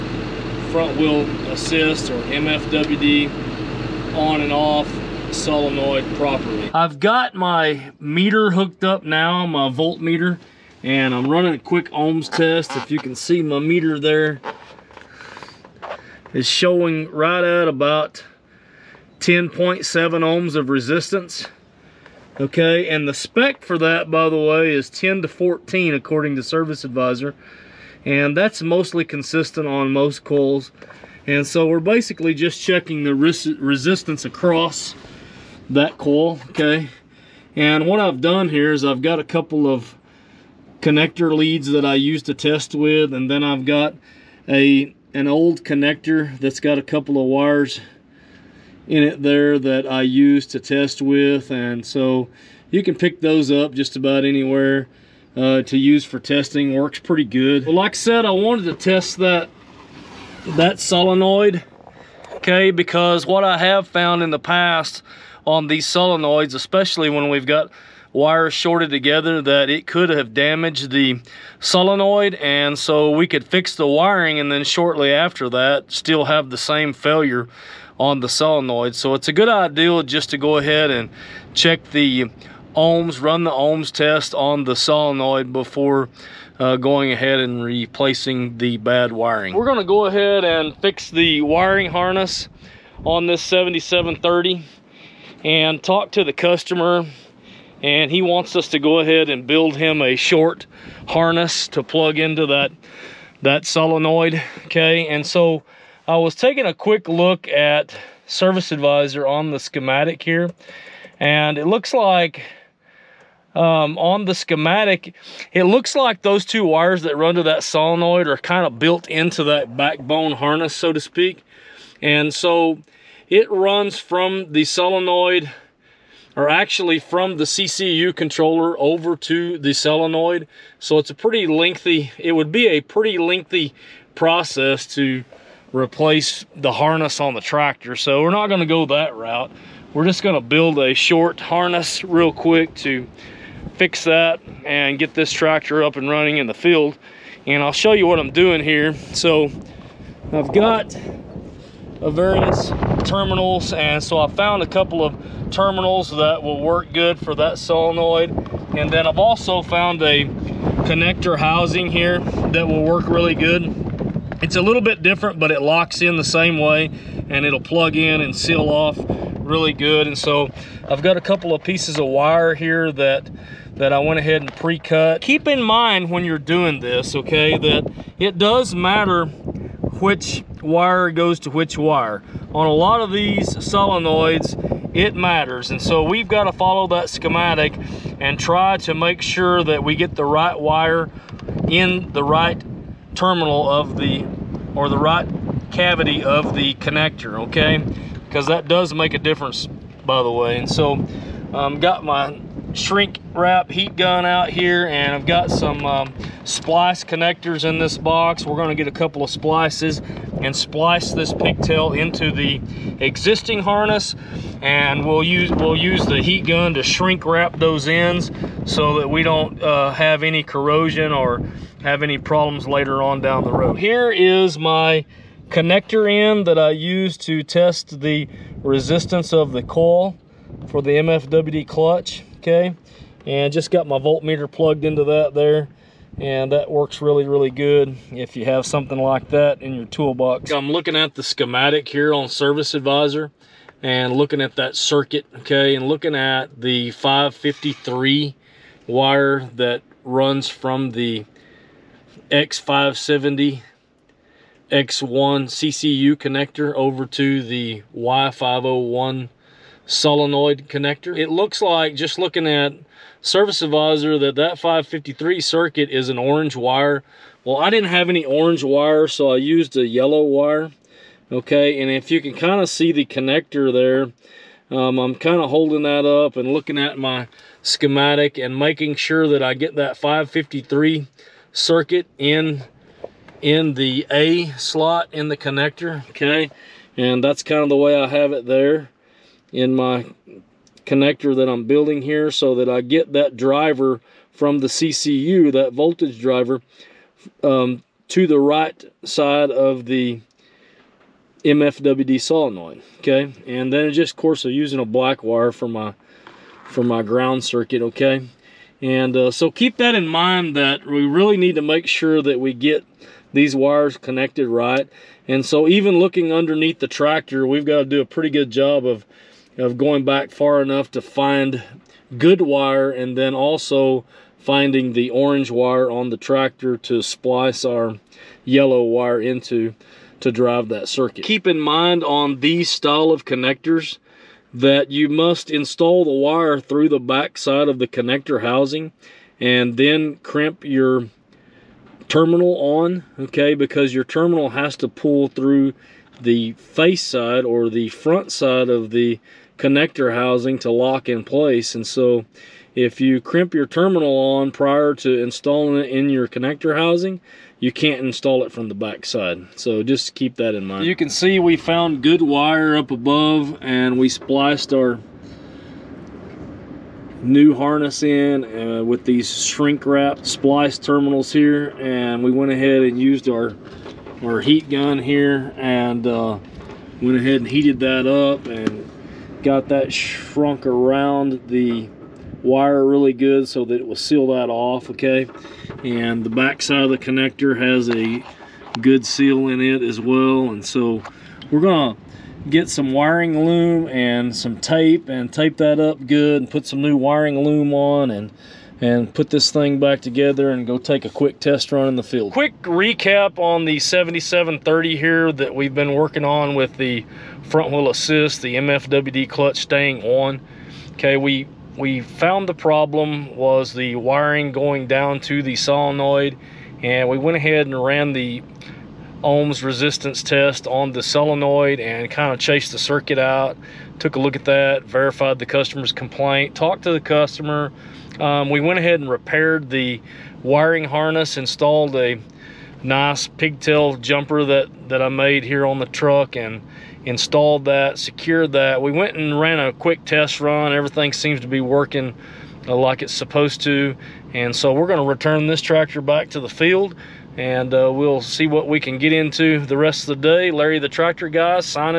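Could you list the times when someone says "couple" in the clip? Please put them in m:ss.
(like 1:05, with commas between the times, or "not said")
0:39, 0:46, 2:34, 2:51, 3:28.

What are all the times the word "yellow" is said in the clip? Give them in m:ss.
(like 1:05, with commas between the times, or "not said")
4:29, 5:28.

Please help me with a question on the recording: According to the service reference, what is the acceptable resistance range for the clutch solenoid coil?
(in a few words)
10 to 14.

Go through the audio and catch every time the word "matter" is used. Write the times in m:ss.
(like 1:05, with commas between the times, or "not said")
2:58, 3:05.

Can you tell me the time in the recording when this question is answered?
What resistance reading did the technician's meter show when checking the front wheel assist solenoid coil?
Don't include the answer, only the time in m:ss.
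0:19.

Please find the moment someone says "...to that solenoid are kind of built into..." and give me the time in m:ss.
1:57.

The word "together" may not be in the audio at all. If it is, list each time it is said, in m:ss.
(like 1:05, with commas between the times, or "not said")
1:08, 6:40.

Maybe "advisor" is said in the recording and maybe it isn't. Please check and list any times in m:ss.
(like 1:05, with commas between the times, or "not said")
0:26, 1:48, 4:02, 4:23.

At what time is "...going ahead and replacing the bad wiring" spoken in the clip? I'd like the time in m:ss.
1:26.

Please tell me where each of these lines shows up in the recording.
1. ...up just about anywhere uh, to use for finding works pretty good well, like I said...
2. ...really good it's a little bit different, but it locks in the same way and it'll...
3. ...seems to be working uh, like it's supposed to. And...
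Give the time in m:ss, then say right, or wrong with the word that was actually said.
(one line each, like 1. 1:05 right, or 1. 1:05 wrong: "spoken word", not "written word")
1. 0:53 wrong: "testing", not "finding"
2. 2:43 right
3. 7:21 right.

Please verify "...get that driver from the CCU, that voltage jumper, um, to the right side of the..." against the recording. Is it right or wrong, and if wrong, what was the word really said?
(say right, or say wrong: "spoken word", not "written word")
wrong: "driver", not "jumper".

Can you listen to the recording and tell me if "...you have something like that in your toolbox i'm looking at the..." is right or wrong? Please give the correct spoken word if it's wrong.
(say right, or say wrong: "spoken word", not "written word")
right.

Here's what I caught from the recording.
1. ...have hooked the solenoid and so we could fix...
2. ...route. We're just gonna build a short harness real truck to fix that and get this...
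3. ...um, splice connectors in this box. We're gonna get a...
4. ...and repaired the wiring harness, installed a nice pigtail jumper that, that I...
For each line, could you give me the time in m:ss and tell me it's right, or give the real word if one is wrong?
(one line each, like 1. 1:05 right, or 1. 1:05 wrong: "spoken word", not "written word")
1. 1:10 wrong: "damaged", not "hooked"
2. 2:19 wrong: "quick", not "truck"
3. 3:25 right
4. 7:08 right.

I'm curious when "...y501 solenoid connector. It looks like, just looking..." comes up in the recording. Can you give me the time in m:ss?
4:17.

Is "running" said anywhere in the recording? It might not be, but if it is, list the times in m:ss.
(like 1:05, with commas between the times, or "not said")
0:11, 2:26.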